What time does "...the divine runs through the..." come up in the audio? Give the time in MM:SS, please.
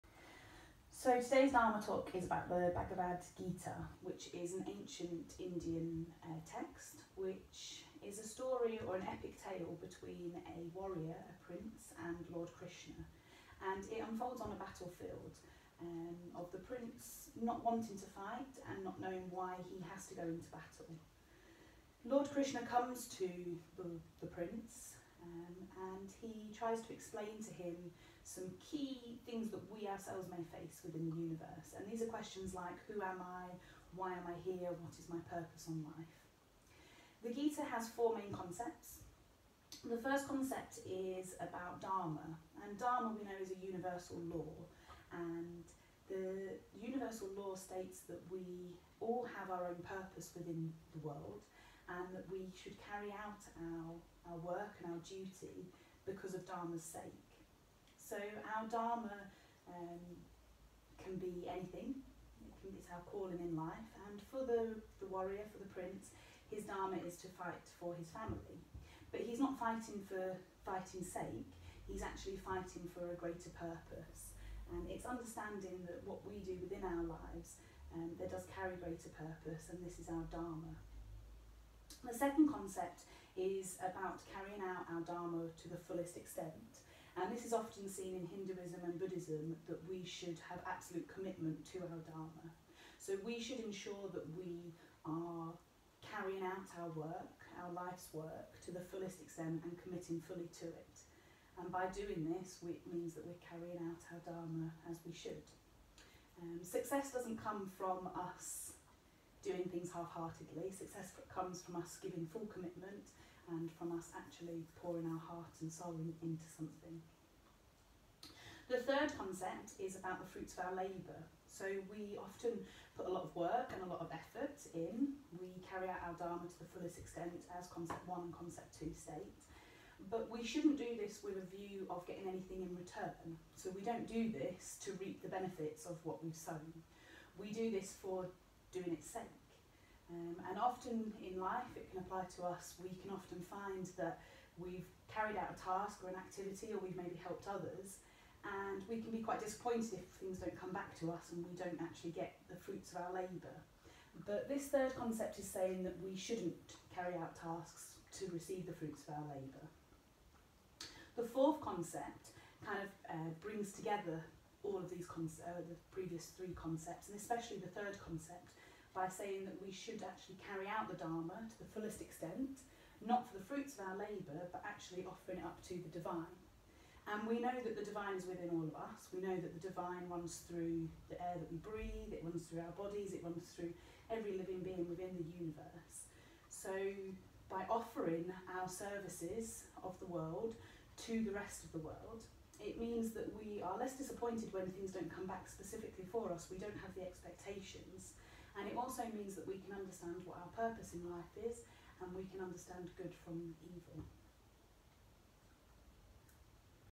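02:59.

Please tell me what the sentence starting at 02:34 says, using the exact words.
But this third concept is saying that we shouldn't carry out tasks to receive the fruits of our labour.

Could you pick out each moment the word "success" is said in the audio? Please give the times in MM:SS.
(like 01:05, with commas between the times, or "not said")
01:46, 01:50.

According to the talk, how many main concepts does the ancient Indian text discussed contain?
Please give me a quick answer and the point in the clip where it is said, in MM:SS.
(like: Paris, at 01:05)
4, at 00:37.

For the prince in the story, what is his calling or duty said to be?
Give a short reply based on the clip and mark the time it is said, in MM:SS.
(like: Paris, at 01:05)
to fight for his family, at 01:07.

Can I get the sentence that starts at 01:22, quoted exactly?
The second concept is about carrying out our Dharma to the fullest extent.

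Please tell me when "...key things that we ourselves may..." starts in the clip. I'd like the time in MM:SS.
00:28.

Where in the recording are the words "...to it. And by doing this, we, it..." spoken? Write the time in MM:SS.
01:40.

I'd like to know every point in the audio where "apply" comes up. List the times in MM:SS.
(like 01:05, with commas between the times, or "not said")
02:22.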